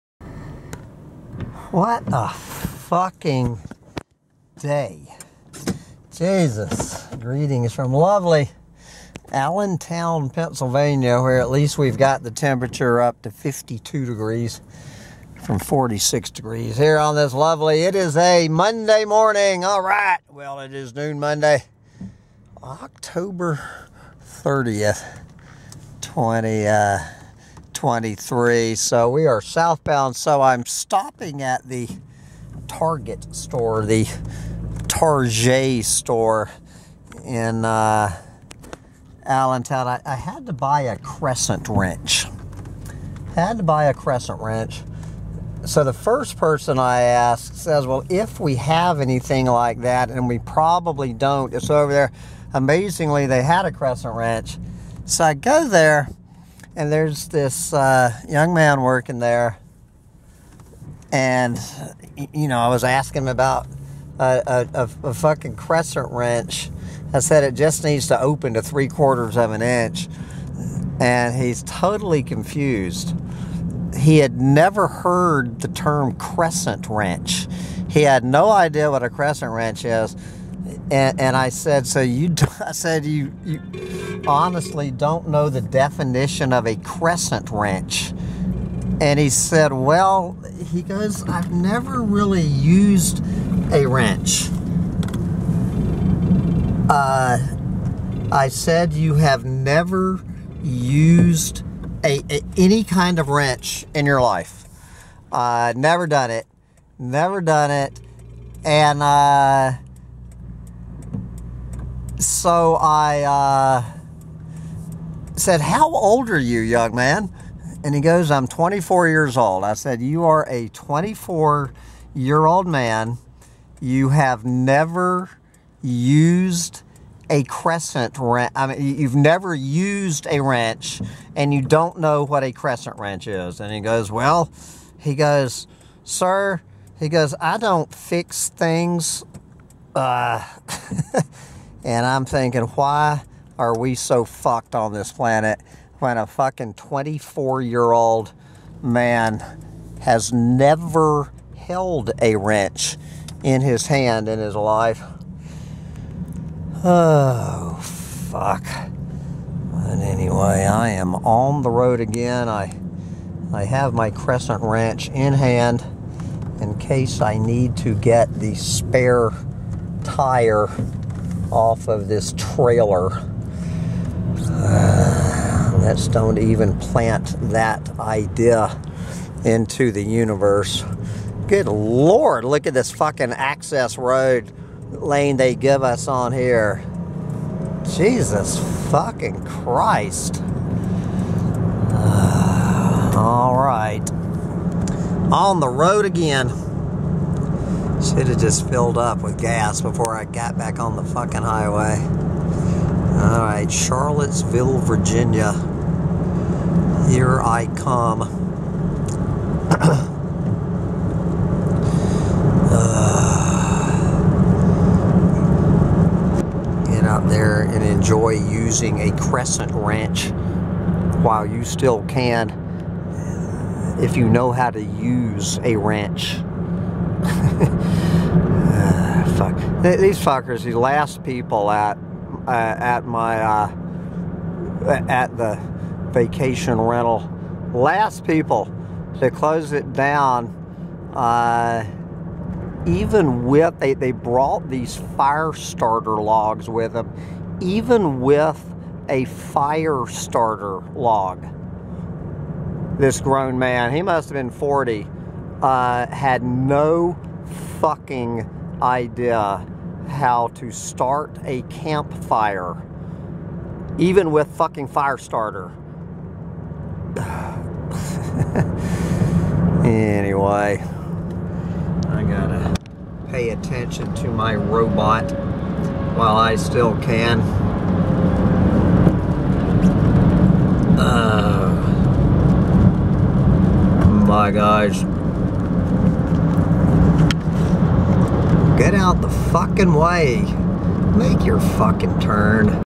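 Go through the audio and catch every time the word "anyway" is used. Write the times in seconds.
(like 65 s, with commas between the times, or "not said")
159 s, 269 s.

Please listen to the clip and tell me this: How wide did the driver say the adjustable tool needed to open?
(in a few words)
3/4 of an inch.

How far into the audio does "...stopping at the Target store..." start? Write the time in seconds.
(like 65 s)
30 s.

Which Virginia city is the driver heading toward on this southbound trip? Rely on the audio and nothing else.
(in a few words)
Charlottesville.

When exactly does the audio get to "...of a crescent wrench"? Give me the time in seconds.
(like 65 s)
86 s.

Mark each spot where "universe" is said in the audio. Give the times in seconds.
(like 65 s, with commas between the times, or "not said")
180 s.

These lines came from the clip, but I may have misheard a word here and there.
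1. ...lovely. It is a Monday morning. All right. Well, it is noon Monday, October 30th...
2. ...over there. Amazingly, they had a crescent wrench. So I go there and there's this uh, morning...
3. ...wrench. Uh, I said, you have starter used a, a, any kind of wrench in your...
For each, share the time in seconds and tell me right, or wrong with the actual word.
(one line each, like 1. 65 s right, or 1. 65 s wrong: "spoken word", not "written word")
1. 17 s right
2. 51 s wrong: "young", not "morning"
3. 93 s wrong: "never", not "starter".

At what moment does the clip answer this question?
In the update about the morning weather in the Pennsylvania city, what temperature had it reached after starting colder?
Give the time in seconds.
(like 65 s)
13 s.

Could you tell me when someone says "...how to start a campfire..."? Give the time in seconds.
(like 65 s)
260 s.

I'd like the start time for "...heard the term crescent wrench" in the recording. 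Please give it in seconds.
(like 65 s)
74 s.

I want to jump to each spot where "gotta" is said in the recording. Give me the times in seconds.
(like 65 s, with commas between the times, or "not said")
272 s.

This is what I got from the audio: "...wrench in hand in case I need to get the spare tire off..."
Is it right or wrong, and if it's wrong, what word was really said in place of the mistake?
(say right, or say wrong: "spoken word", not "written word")
right.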